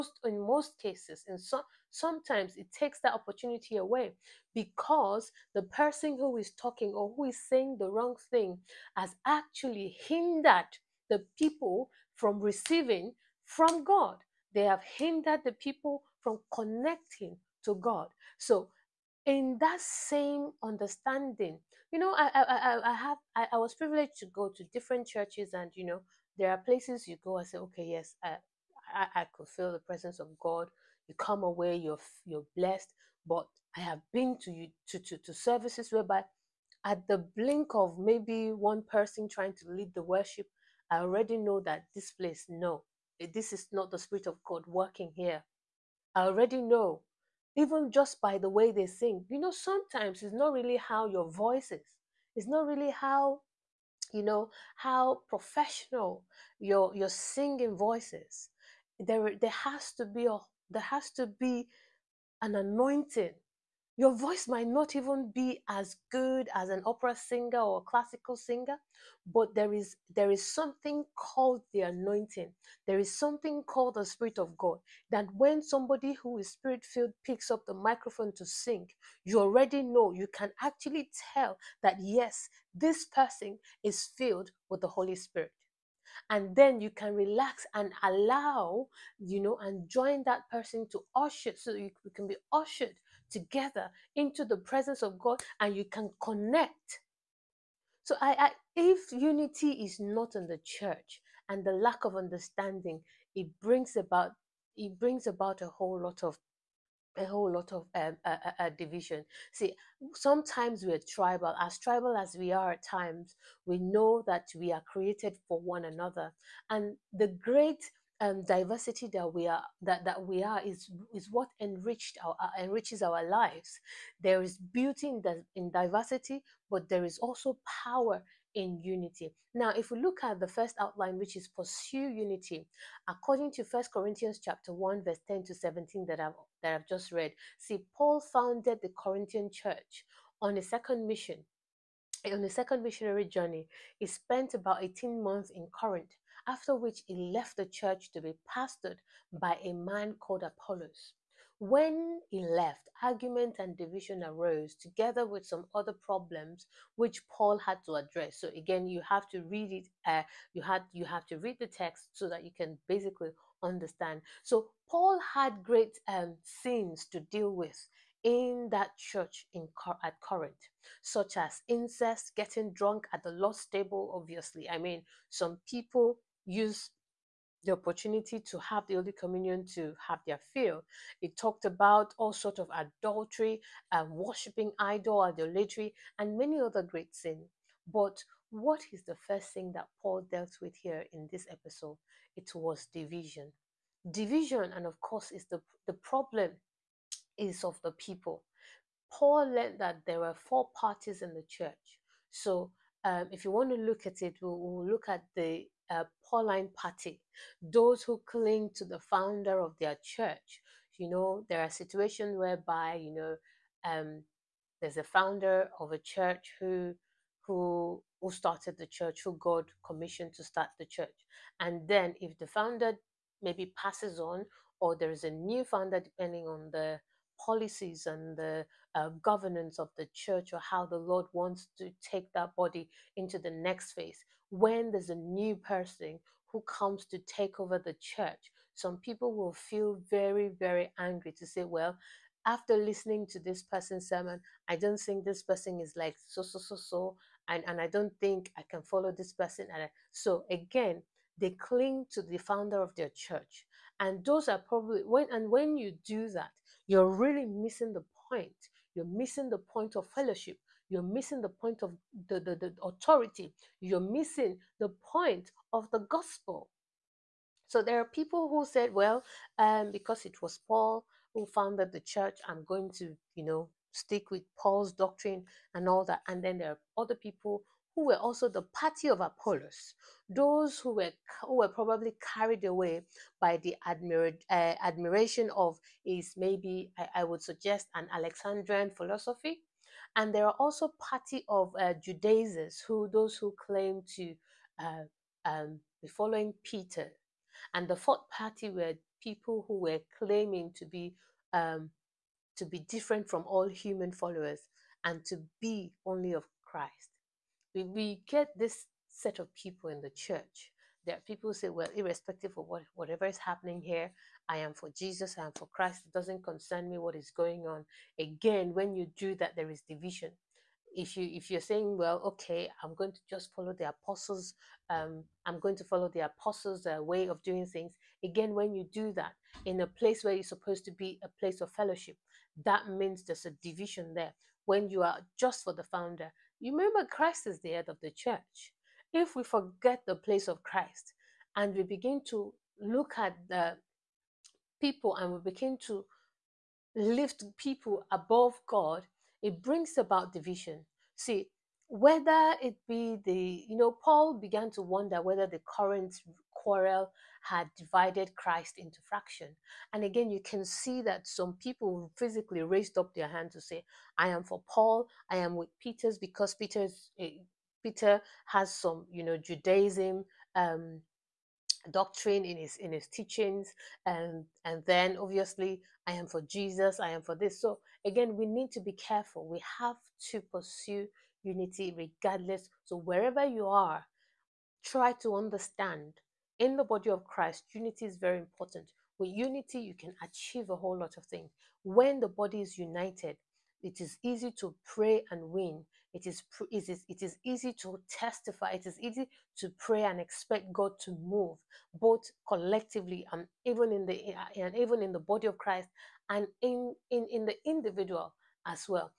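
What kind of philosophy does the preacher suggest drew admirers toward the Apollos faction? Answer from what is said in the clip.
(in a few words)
Alexandrian philosophy.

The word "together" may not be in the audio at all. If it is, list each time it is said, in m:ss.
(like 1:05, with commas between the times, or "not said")
1:33, 2:34.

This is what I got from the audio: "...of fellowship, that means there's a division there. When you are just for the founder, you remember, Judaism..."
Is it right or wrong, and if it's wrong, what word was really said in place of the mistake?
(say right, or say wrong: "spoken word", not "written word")
wrong: "Christ", not "Judaism".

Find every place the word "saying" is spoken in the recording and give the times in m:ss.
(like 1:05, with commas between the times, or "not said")
0:07, 5:21.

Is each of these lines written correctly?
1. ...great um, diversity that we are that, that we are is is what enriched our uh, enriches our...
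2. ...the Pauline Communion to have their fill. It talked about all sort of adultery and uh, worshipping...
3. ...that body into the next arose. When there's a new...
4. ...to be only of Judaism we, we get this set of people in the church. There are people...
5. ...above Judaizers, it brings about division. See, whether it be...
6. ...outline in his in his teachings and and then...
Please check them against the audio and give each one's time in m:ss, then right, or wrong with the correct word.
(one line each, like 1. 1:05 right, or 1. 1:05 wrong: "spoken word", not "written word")
1. 1:57 right
2. 2:58 wrong: "Holy", not "Pauline"
3. 3:52 wrong: "phase", not "arose"
4. 5:05 wrong: "Christ", not "Judaism"
5. 5:48 wrong: "God", not "Judaizers"
6. 6:11 wrong: "doctrine", not "outline".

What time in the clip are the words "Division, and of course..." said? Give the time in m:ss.
3:14.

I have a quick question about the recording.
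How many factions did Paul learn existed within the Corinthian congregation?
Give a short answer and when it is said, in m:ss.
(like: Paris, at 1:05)
4, at 3:20.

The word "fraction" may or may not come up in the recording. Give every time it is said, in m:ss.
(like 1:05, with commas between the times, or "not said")
5:59.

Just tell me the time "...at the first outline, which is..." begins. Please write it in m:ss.
2:10.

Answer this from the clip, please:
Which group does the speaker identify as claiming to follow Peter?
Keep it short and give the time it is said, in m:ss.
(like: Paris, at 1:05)
Judaizers, at 4:52.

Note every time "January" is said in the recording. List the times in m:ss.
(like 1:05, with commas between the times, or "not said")
not said.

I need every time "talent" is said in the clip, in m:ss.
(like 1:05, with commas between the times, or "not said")
not said.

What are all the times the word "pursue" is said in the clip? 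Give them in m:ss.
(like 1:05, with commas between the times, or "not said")
2:11, 6:20.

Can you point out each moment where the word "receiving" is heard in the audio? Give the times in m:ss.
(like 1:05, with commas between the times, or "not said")
0:12.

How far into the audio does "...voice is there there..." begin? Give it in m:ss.
0:57.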